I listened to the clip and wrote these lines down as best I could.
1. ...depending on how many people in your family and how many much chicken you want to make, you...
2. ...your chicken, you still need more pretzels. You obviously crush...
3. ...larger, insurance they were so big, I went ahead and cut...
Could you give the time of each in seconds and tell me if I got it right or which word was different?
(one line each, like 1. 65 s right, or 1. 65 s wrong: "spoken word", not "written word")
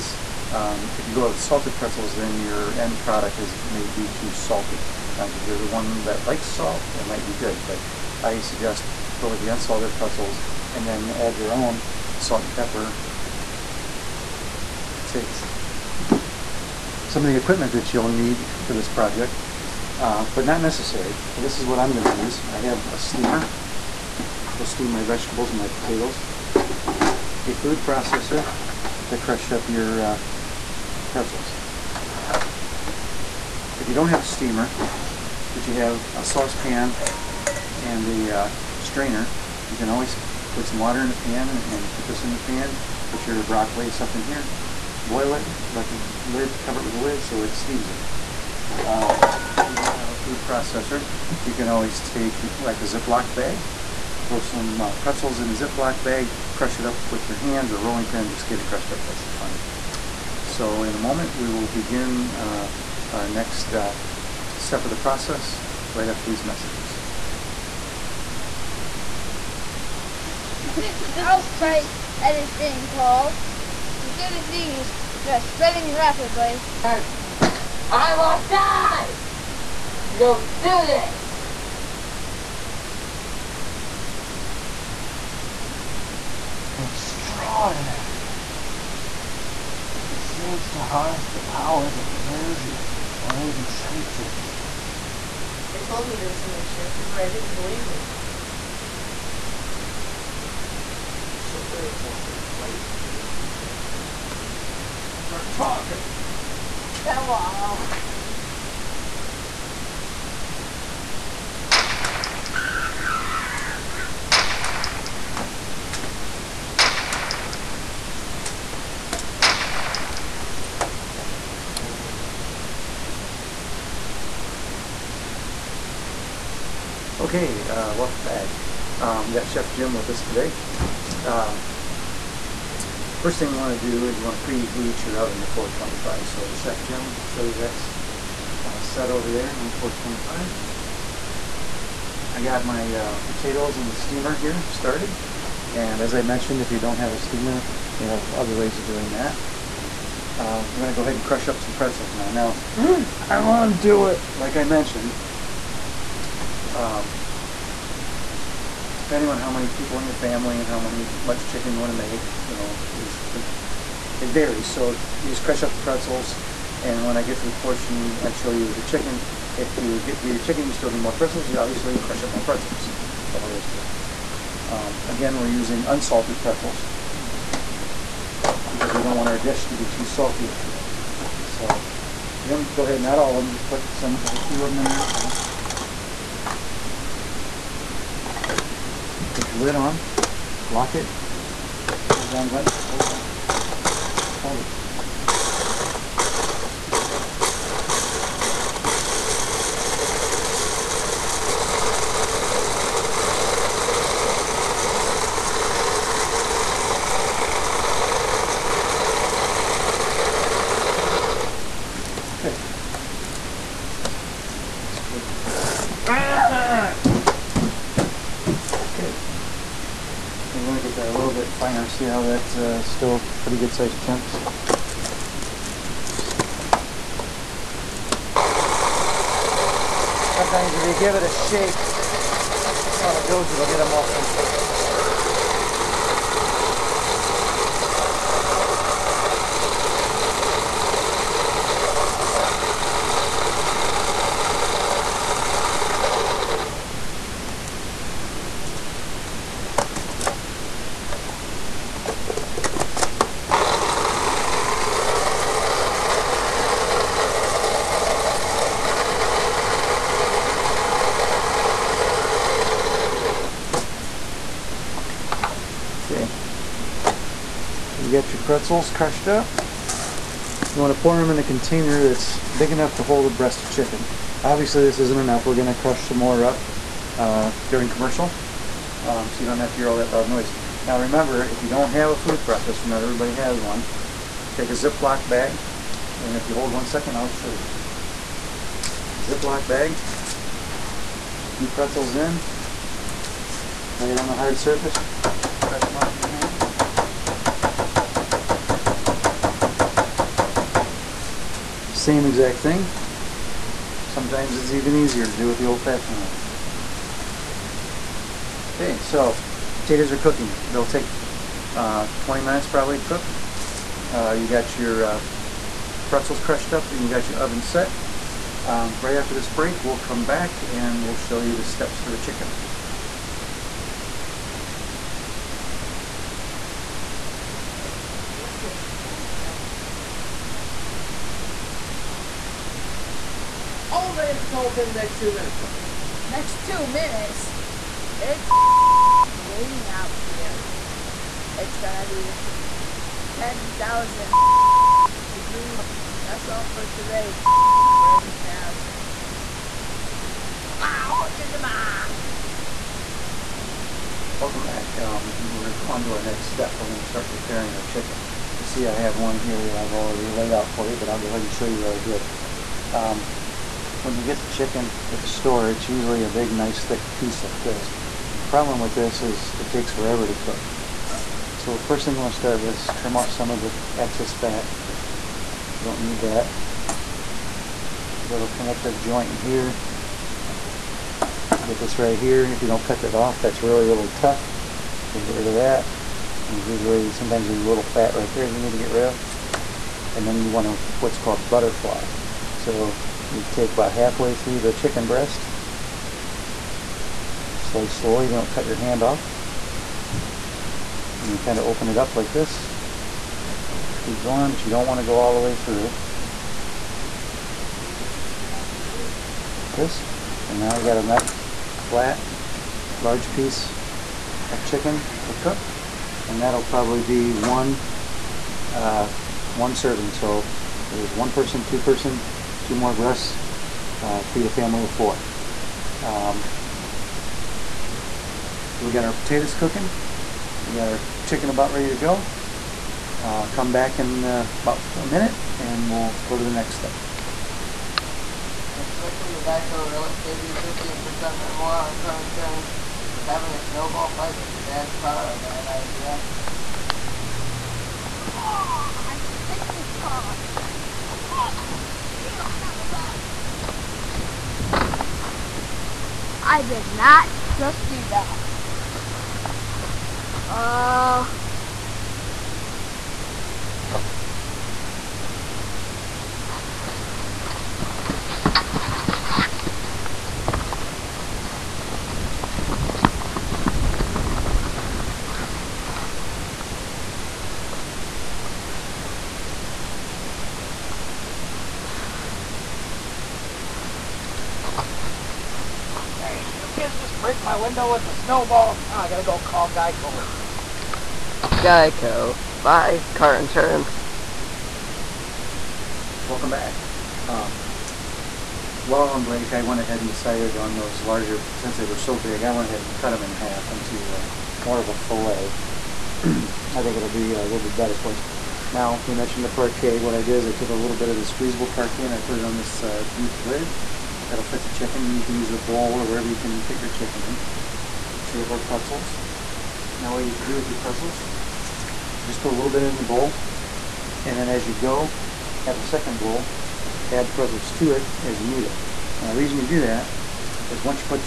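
1. 159 s right
2. 170 s right
3. 501 s wrong: "since", not "insurance".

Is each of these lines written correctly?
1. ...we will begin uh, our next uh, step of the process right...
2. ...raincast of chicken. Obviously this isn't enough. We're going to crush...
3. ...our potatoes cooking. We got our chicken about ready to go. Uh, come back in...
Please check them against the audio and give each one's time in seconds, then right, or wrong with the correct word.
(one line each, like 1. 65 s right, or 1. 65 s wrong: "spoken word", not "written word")
1. 61 s right
2. 273 s wrong: "breast", not "raincast"
3. 429 s right.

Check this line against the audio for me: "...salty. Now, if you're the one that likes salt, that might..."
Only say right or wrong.
right.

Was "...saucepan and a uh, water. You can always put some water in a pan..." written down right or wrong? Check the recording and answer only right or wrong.
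wrong.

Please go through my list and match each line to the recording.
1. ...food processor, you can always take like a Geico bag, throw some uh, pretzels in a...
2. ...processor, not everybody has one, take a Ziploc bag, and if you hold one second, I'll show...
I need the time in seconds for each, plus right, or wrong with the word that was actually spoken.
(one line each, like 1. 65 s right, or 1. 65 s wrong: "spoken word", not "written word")
1. 50 s wrong: "Ziploc", not "Geico"
2. 282 s right.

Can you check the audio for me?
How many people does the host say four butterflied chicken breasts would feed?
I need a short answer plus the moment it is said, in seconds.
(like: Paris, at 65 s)
a family of four, at 424 s.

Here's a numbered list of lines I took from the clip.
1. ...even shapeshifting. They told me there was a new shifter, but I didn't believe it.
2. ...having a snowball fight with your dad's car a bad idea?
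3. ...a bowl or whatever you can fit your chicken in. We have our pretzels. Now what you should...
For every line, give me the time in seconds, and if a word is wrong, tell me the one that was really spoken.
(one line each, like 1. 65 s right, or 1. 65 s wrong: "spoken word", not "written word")
1. 93 s right
2. 443 s right
3. 515 s right.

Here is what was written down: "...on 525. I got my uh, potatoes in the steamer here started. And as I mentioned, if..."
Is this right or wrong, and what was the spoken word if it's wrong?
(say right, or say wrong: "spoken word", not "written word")
wrong: "425", not "525".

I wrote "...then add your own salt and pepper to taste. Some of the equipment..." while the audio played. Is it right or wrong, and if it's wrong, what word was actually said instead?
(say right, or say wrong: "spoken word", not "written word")
right.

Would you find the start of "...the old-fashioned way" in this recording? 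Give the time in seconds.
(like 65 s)
305 s.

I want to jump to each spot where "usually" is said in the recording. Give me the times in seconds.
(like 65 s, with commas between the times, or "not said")
365 s, 386 s.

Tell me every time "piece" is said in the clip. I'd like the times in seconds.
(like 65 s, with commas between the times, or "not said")
367 s, 413 s.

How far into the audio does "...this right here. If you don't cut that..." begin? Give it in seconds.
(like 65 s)
381 s.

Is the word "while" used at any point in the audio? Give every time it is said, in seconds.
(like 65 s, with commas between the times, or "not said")
498 s.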